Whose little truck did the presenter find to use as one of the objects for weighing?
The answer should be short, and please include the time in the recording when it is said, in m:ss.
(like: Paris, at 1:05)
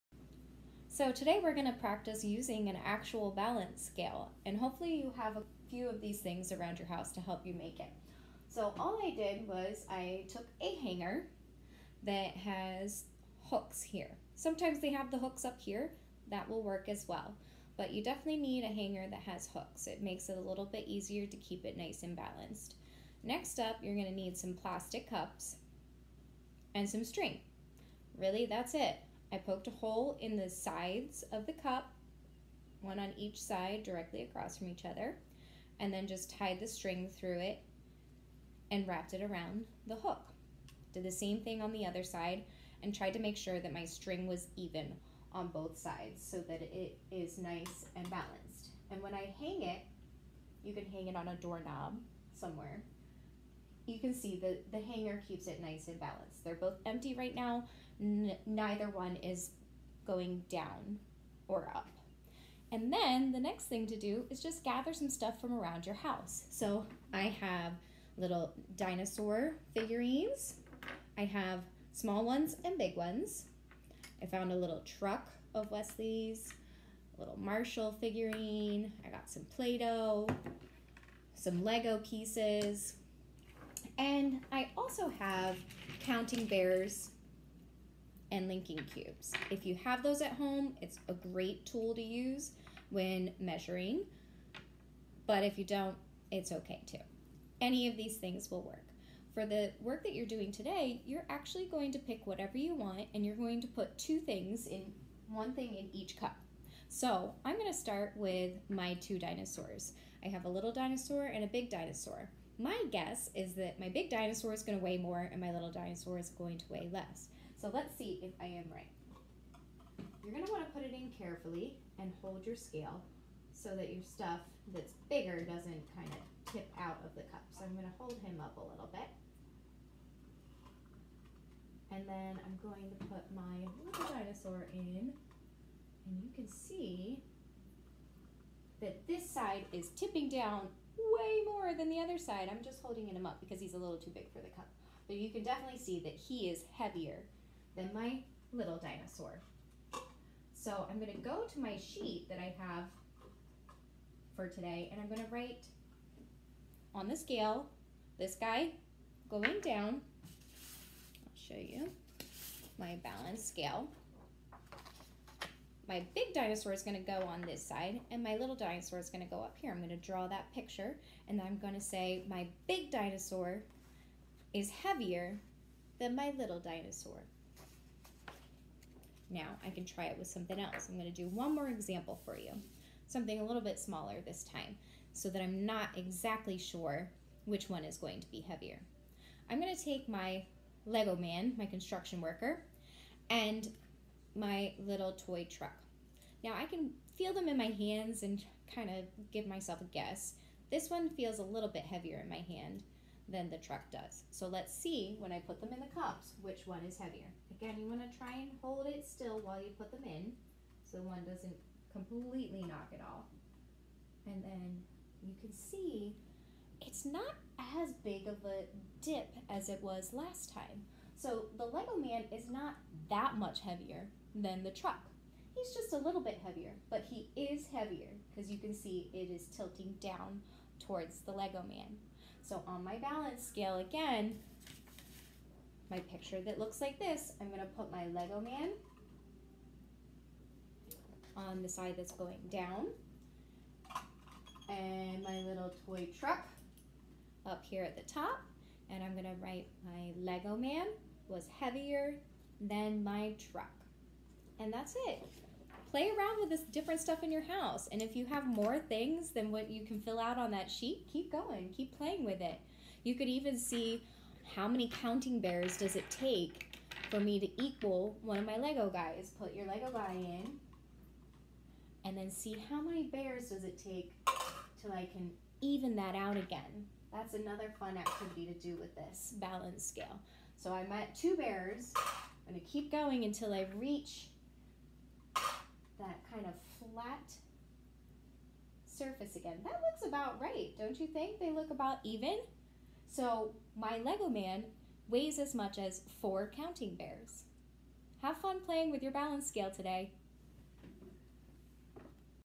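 Wesley's, at 1:15.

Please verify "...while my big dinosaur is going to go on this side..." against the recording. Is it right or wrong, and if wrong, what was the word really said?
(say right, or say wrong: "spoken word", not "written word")
wrong: "scale", not "while".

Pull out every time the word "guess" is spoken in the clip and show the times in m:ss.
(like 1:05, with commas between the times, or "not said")
1:52, 3:19.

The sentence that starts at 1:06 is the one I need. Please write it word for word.
So I have little dinosaur figurines.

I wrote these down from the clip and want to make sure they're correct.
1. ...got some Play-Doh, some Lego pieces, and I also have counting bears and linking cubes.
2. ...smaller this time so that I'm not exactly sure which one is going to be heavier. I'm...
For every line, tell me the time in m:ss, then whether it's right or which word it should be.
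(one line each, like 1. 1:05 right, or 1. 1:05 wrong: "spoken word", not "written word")
1. 1:19 right
2. 3:03 right.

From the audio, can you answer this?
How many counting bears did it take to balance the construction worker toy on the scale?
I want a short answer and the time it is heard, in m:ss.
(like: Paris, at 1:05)
4, at 4:56.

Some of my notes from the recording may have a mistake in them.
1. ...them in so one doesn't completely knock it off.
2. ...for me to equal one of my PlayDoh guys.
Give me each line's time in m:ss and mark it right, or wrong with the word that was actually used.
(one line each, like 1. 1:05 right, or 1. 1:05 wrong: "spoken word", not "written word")
1. 3:29 right
2. 4:27 wrong: "Lego", not "PlayDoh".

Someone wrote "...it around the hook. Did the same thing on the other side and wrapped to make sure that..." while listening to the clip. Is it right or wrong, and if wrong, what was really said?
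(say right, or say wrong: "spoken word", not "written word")
wrong: "tried", not "wrapped".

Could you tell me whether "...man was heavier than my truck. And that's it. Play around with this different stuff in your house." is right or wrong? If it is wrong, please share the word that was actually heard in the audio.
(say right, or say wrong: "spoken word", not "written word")
right.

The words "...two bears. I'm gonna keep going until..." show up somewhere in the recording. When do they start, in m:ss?
4:41.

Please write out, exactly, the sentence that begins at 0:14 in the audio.
Sometimes they have the hooks up here, that will work as well.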